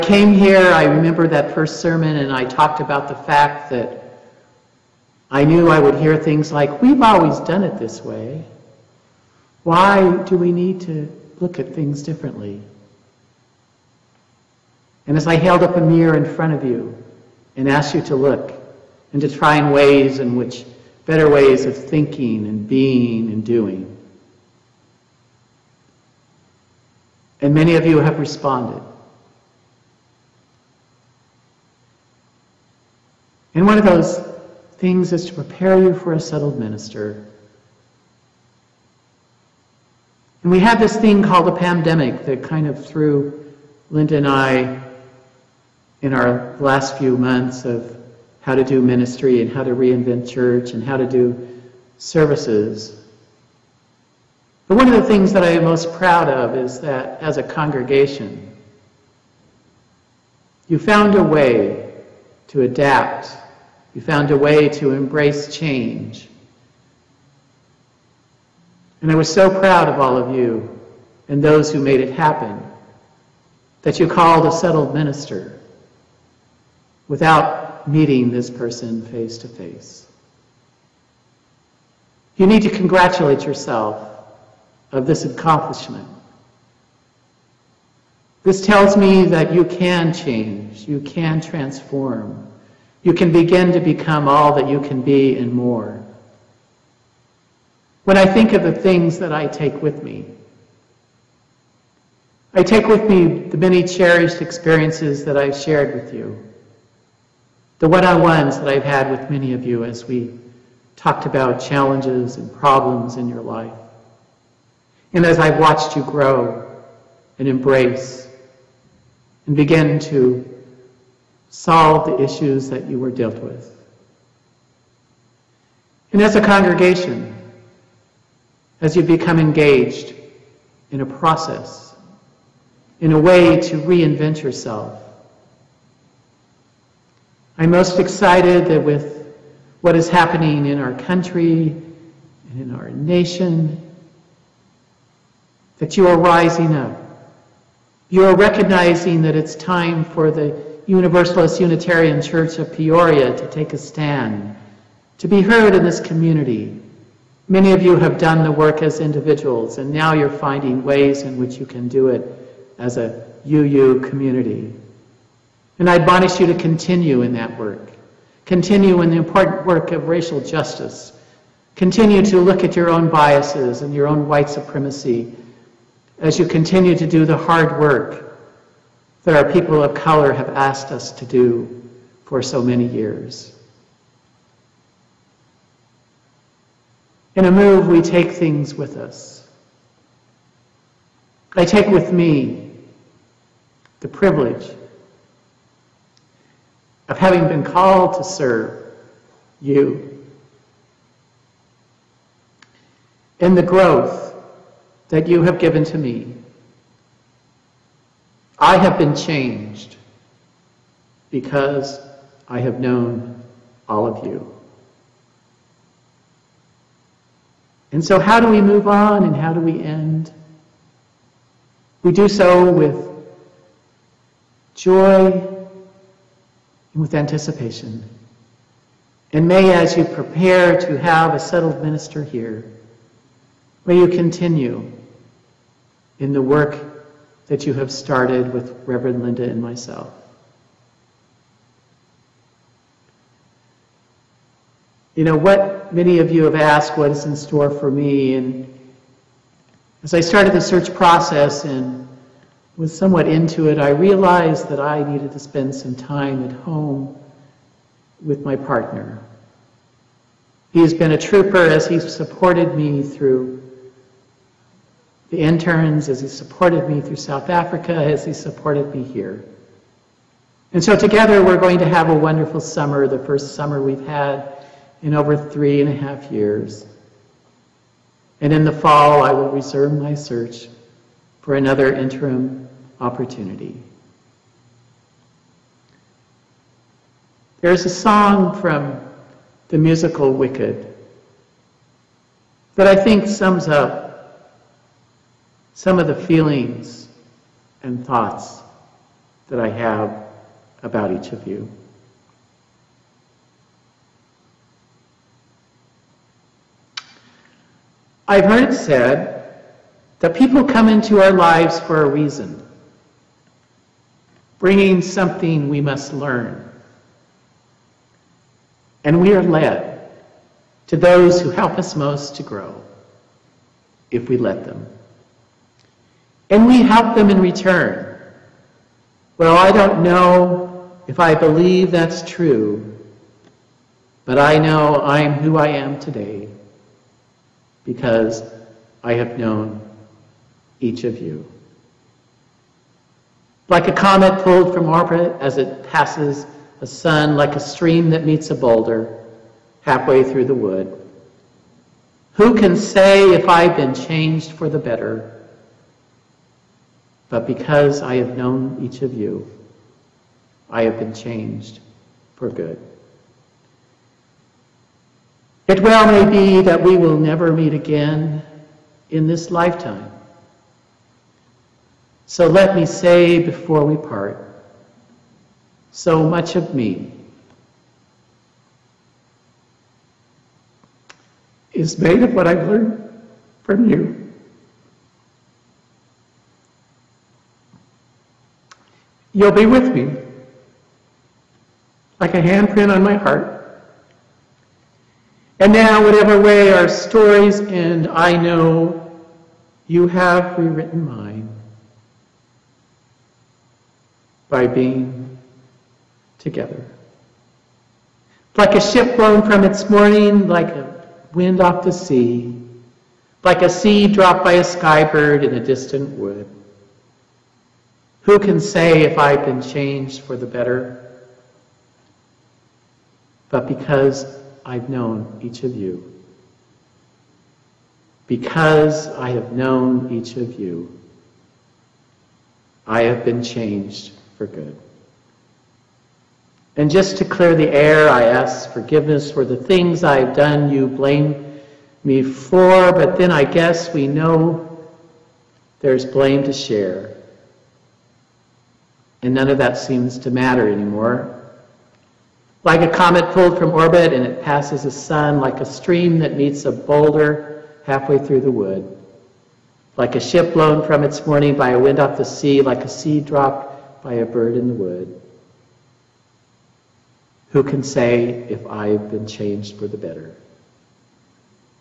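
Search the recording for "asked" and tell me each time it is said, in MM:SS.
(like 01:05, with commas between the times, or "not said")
00:17, 03:00, 04:06.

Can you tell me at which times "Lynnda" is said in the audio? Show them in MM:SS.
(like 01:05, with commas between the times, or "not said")
00:43, 03:59.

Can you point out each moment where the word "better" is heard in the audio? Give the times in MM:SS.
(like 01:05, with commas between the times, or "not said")
00:21, 05:54, 07:00, 07:49.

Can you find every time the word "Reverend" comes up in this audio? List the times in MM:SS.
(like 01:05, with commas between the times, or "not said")
03:58.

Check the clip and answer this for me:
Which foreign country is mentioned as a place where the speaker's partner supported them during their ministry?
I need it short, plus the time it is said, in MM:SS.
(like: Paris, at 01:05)
South Africa, at 04:27.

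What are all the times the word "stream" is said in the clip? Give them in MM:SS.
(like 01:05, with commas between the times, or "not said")
05:47, 07:35.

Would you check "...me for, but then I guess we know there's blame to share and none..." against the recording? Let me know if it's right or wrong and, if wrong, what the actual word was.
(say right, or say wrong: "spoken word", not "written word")
right.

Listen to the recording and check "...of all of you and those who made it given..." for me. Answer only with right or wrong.
wrong.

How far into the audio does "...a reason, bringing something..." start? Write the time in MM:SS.
05:12.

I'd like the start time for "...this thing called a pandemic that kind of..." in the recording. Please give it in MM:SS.
00:40.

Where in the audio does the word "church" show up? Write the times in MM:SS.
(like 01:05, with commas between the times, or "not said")
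00:50, 02:32.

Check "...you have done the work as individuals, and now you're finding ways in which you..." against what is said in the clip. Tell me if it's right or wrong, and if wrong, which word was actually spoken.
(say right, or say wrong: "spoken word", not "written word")
right.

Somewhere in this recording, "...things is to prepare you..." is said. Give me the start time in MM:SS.
00:34.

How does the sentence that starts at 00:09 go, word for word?
Why do we need to look at things differently?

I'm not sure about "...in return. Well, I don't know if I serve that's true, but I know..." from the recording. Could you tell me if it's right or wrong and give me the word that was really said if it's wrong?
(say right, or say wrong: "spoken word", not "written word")
wrong: "believe", not "serve".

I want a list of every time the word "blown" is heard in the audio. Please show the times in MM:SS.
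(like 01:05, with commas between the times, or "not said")
06:49, 07:40.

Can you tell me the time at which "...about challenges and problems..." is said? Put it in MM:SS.
01:51.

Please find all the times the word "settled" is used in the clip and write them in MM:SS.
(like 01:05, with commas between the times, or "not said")
00:36, 01:14, 03:51.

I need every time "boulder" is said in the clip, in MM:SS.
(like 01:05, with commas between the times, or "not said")
05:48, 07:36.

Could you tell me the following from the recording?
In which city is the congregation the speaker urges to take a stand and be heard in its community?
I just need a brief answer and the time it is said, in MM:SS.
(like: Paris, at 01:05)
Peoria, at 02:32.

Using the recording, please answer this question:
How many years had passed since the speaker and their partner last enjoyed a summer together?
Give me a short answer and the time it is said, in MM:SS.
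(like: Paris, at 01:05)
3.5 years, at 04:35.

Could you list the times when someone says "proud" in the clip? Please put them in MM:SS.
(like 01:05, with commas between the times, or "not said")
00:55, 01:09.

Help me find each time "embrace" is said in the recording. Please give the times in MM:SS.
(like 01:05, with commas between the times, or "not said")
01:04, 01:57.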